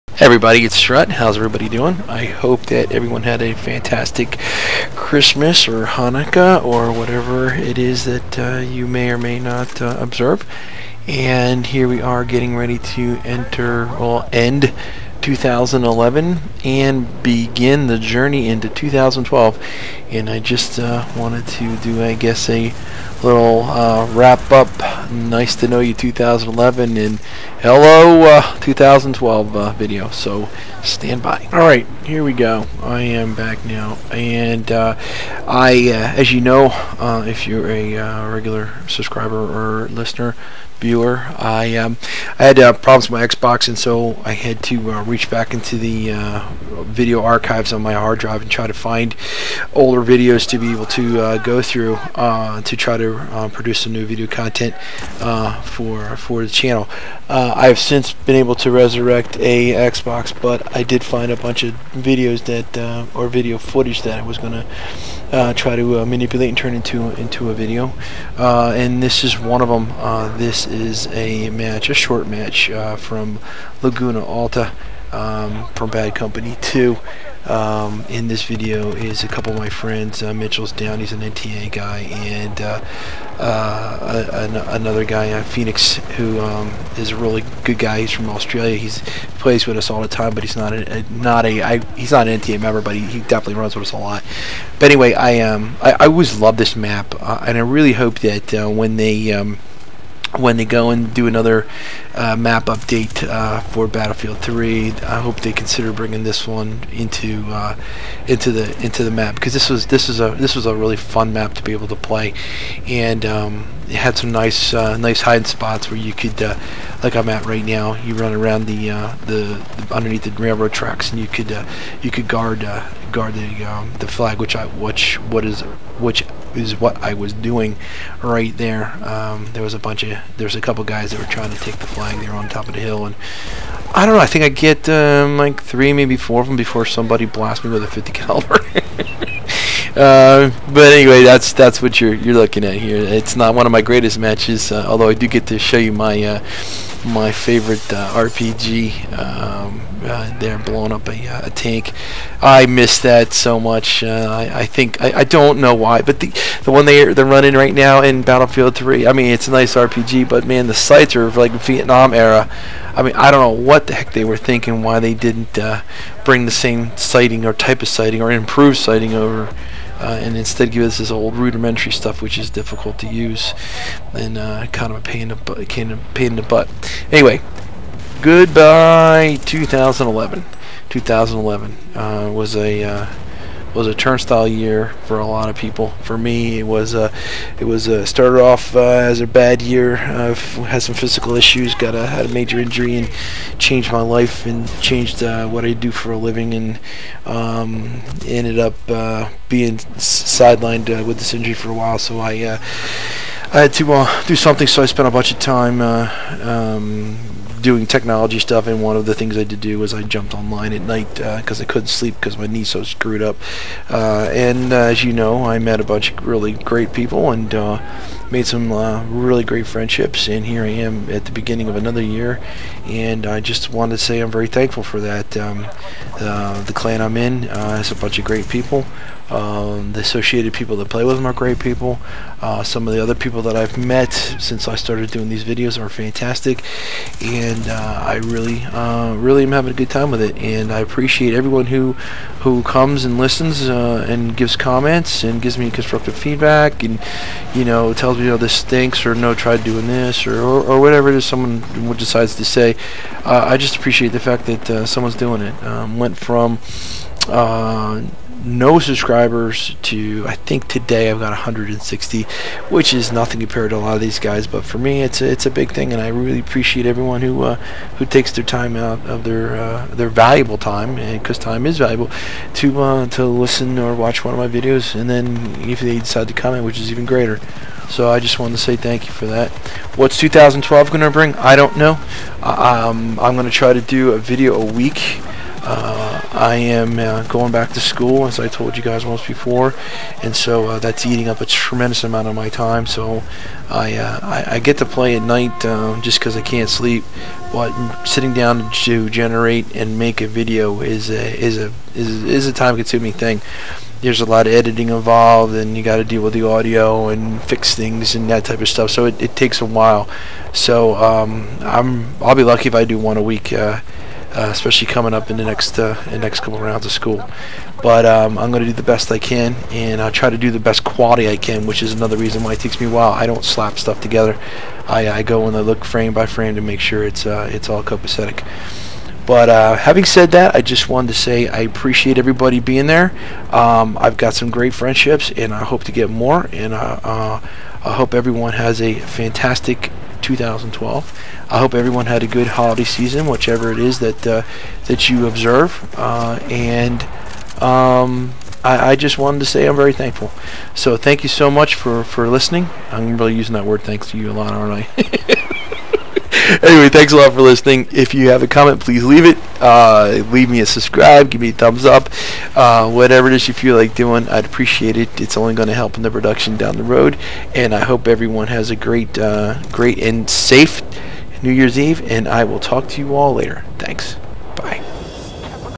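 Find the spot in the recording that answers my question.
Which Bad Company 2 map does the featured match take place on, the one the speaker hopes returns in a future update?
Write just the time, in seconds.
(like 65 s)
73 s.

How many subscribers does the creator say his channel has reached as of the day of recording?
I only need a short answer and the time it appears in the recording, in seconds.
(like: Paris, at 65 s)
160, at 261 s.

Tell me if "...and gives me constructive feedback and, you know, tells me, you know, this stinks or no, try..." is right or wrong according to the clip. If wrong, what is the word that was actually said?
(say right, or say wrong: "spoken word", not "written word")
right.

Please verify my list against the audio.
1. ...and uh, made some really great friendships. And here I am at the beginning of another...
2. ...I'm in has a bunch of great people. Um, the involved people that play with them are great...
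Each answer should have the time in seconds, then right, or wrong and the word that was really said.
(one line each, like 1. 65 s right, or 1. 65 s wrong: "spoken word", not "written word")
1. 217 s right
2. 227 s wrong: "associated", not "involved".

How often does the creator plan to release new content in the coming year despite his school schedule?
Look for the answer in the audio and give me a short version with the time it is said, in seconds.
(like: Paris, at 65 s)
a video a week, at 284 s.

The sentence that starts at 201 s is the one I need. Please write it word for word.
So I I had to uh, do something, so I spent a bunch of time uh, um, doing technology stuff.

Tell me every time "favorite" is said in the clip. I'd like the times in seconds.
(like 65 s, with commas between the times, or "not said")
147 s.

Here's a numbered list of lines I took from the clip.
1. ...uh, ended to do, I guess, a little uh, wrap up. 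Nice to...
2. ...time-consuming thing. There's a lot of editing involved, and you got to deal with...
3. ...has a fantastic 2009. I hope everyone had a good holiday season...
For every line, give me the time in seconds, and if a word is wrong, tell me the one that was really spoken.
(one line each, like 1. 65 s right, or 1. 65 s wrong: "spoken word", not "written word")
1. 20 s wrong: "wanted", not "ended"
2. 302 s right
3. 338 s wrong: "2012", not "2009".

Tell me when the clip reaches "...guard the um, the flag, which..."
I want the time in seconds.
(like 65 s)
123 s.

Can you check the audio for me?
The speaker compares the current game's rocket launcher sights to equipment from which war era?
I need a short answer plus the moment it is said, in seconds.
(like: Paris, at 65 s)
Vietnam, at 161 s.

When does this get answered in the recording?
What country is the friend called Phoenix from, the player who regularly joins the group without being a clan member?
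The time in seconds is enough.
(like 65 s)
88 s.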